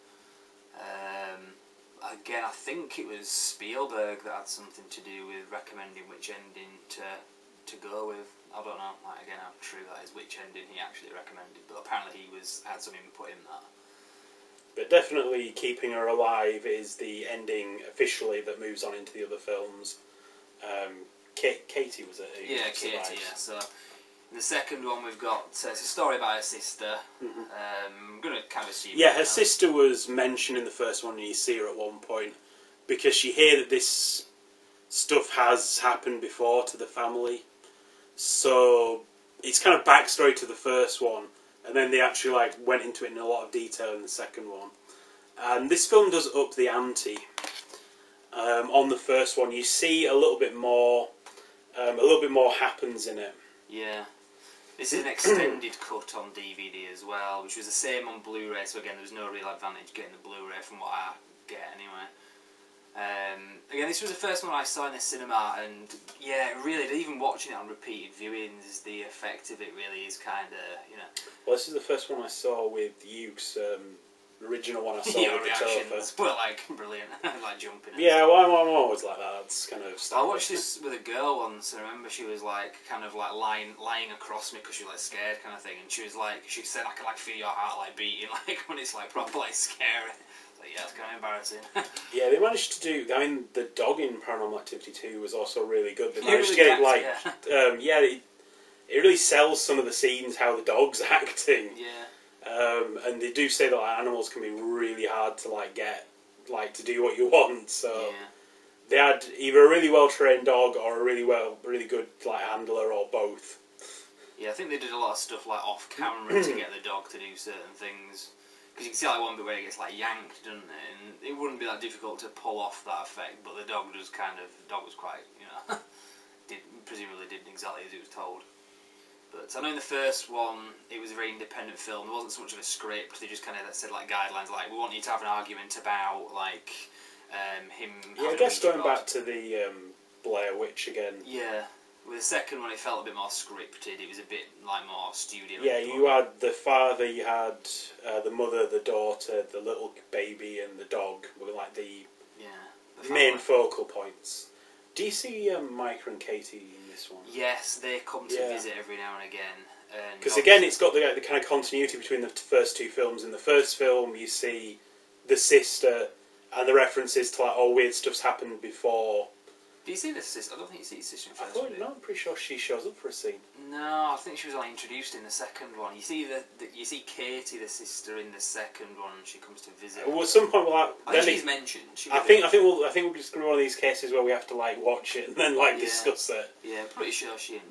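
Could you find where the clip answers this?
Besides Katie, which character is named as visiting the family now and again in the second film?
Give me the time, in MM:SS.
02:35.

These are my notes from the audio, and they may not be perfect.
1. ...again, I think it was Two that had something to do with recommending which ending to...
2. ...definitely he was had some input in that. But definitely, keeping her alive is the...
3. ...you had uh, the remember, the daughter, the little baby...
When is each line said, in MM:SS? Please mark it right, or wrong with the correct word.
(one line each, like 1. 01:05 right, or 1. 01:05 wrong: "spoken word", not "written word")
1. 00:02 wrong: "Spielberg", not "Two"
2. 00:11 wrong: "apparently", not "definitely"
3. 02:27 wrong: "mother", not "remember".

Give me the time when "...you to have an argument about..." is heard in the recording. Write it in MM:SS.
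02:14.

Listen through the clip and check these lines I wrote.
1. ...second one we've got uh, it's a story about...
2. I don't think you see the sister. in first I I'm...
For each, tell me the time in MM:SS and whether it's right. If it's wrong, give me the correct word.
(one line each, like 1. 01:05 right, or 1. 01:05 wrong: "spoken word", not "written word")
1. 00:24 right
2. 02:50 right.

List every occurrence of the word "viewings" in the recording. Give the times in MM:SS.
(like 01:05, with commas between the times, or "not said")
01:08.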